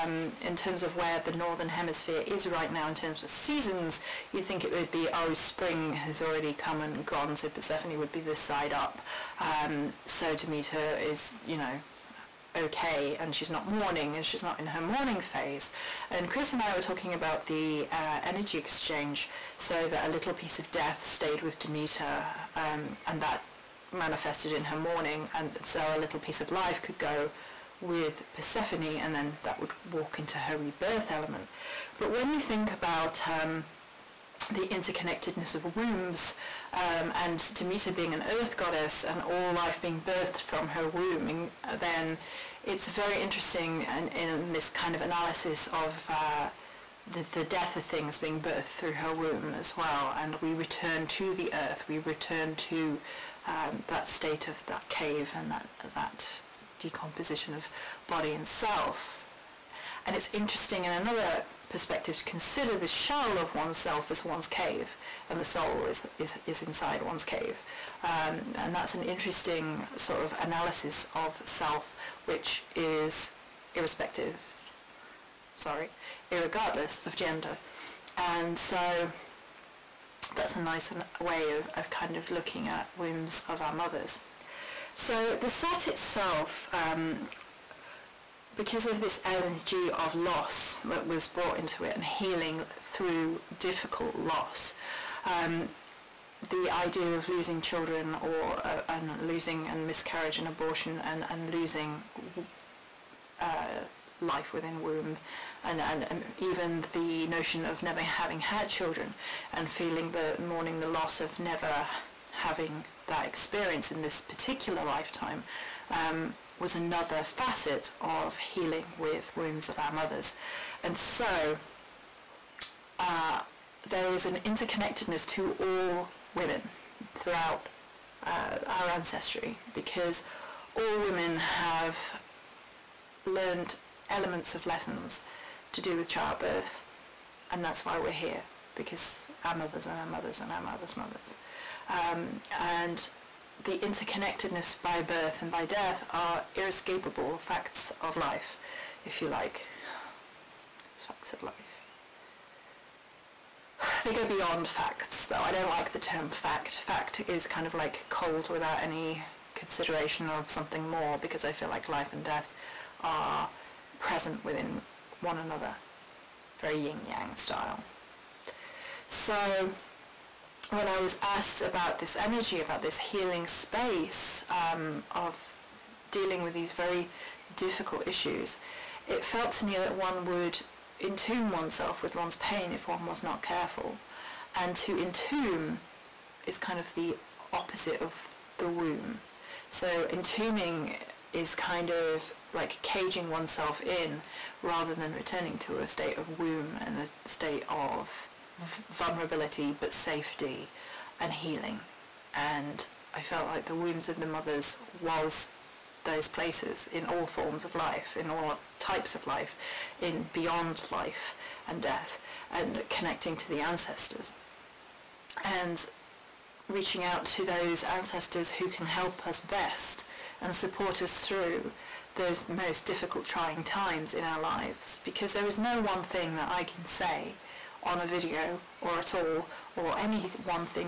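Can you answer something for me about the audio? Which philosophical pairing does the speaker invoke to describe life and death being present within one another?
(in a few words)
yin-yang.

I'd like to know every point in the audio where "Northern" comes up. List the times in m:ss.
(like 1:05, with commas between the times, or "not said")
0:01.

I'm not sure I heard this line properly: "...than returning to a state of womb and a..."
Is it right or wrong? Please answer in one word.
right.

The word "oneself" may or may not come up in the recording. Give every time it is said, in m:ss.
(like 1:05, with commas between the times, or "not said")
1:03, 3:01, 3:13.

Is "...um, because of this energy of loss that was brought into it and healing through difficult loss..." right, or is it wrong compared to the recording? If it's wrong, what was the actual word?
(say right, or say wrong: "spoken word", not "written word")
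right.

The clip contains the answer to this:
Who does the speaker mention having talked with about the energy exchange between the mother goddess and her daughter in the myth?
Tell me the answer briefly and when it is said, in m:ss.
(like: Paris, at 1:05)
Chris, at 0:16.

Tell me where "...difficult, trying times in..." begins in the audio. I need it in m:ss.
3:42.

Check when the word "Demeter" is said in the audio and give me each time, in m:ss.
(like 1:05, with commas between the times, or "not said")
0:10, 0:21, 0:37.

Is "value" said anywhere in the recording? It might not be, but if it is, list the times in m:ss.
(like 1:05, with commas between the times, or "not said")
not said.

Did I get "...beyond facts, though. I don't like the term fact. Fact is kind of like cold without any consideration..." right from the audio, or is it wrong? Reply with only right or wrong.
right.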